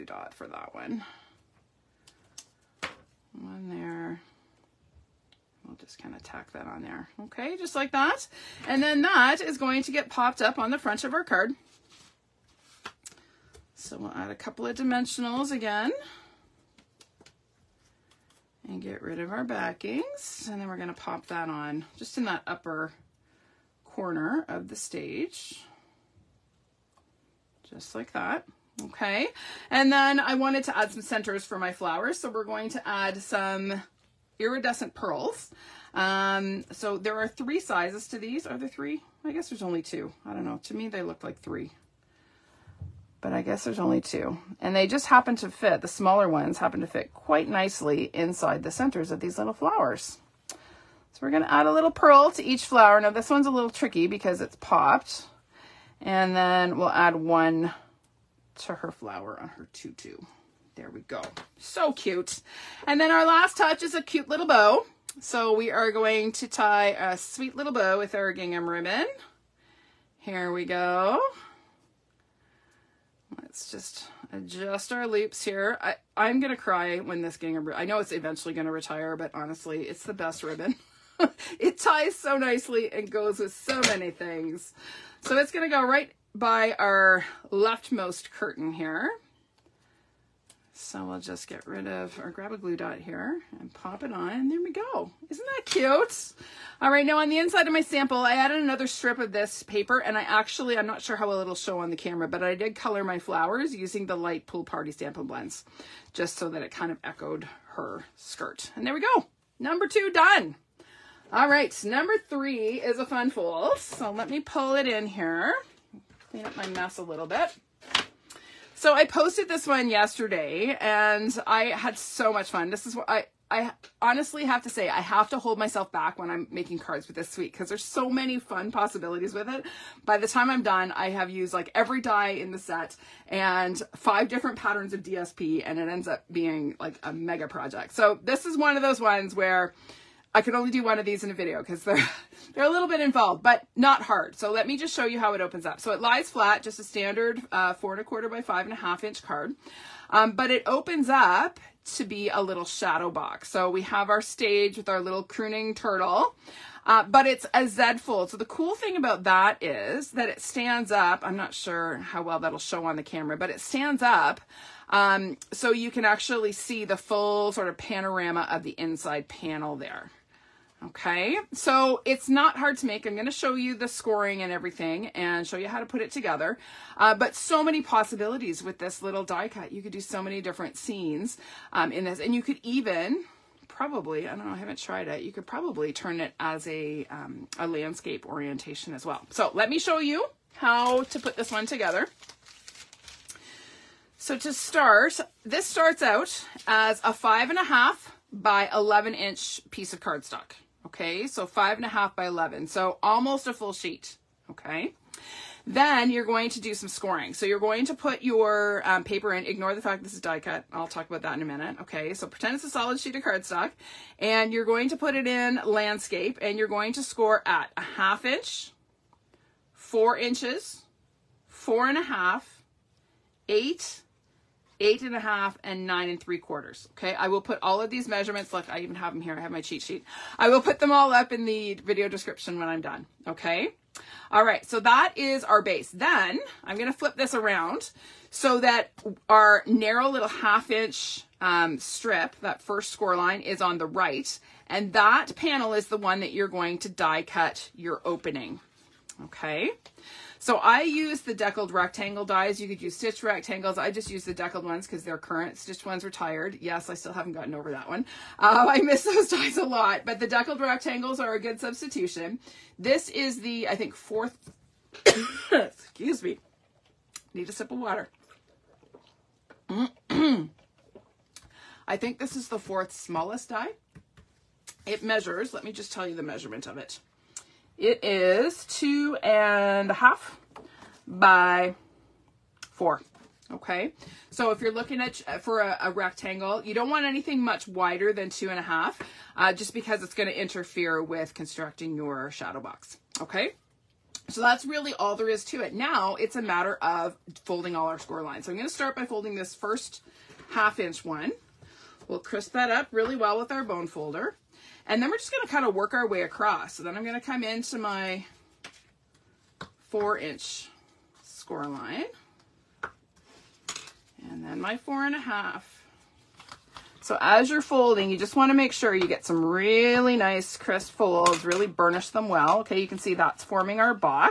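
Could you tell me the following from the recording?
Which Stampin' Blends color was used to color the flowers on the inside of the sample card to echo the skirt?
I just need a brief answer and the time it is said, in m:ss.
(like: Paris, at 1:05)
light pool party, at 1:44.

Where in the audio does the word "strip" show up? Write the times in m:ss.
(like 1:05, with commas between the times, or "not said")
1:38, 4:01.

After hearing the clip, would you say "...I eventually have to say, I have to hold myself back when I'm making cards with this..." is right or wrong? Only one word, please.
wrong.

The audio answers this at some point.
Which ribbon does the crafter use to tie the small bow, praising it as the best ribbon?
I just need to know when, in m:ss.
1:08.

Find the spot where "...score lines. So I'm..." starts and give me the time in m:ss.
4:57.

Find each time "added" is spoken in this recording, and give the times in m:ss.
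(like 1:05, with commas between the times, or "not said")
1:38.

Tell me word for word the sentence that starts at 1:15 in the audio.
I, I'm going to cry when this gingham, I know it's eventually going to retire, but honestly, it's the best ribbon.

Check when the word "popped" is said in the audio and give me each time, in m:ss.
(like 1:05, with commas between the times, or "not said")
0:10, 0:54.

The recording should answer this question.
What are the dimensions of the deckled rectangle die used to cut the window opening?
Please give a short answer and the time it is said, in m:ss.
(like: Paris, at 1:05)
2.5 by 4 inches, at 4:38.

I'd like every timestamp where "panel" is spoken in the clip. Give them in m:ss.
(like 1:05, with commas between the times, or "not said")
2:49, 4:05.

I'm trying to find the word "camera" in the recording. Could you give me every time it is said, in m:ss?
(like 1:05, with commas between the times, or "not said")
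1:41, 2:43.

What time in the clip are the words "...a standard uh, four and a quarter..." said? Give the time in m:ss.
2:26.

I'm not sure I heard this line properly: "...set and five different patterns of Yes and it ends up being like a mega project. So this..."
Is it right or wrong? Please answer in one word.
wrong.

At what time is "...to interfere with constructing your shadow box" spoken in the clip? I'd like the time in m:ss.
4:50.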